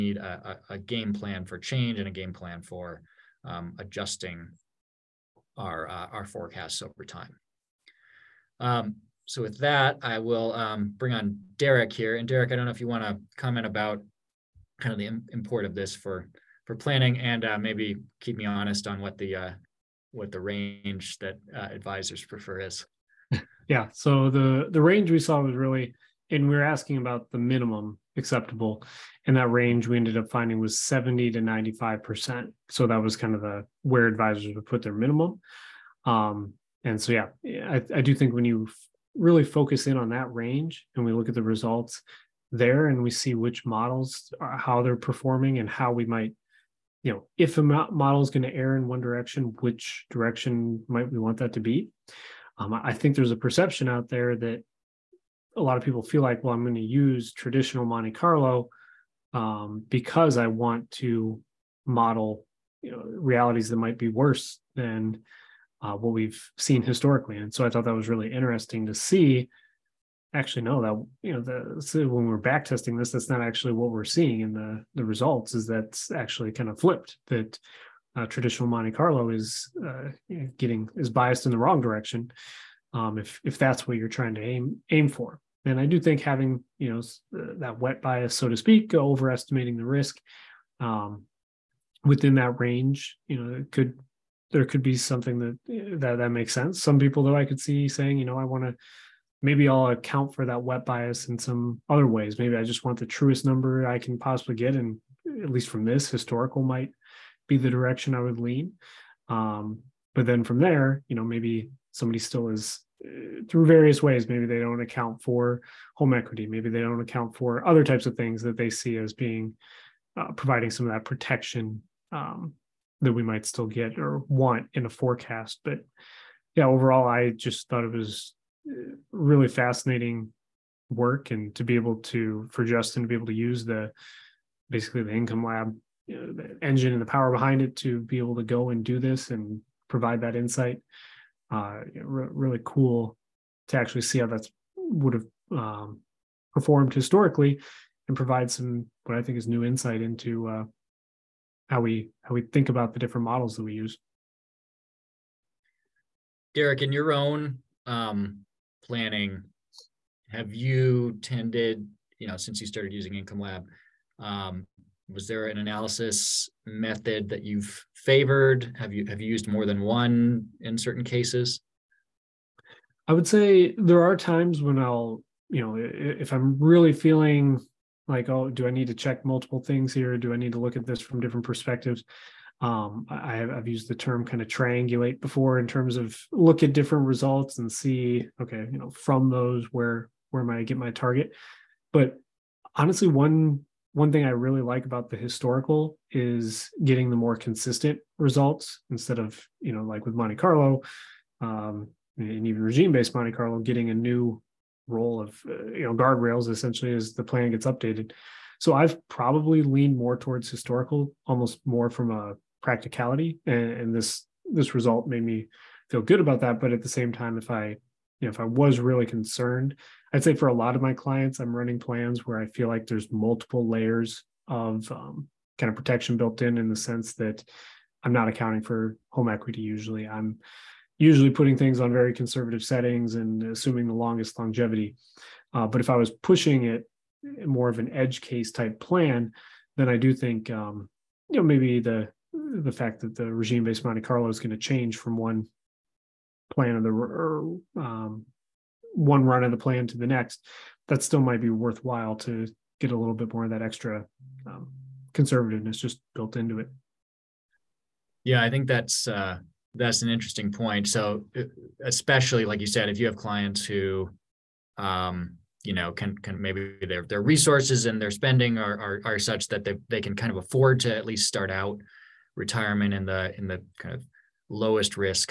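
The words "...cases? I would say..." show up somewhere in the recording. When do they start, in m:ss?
2:51.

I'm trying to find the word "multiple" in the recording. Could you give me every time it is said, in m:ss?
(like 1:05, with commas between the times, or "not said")
2:59, 3:43.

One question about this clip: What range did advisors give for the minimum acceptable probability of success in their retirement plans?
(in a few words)
70 to 95 percent.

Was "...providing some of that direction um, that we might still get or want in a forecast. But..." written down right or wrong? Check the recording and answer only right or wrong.
wrong.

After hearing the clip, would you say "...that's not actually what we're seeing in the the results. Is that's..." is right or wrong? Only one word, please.
right.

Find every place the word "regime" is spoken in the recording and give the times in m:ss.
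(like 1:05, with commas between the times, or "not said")
3:22, 4:03.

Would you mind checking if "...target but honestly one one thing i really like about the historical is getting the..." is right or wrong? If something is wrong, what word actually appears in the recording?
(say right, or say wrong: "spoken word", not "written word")
right.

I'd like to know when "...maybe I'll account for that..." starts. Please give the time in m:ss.
1:39.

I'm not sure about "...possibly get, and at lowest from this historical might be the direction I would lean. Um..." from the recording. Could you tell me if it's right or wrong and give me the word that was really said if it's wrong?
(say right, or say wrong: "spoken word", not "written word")
wrong: "least", not "lowest".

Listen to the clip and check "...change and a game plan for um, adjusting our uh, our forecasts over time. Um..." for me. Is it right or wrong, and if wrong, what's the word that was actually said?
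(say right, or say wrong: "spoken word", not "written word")
right.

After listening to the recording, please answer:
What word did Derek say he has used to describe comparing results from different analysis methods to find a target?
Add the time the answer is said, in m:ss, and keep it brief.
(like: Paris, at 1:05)
triangulate, at 3:04.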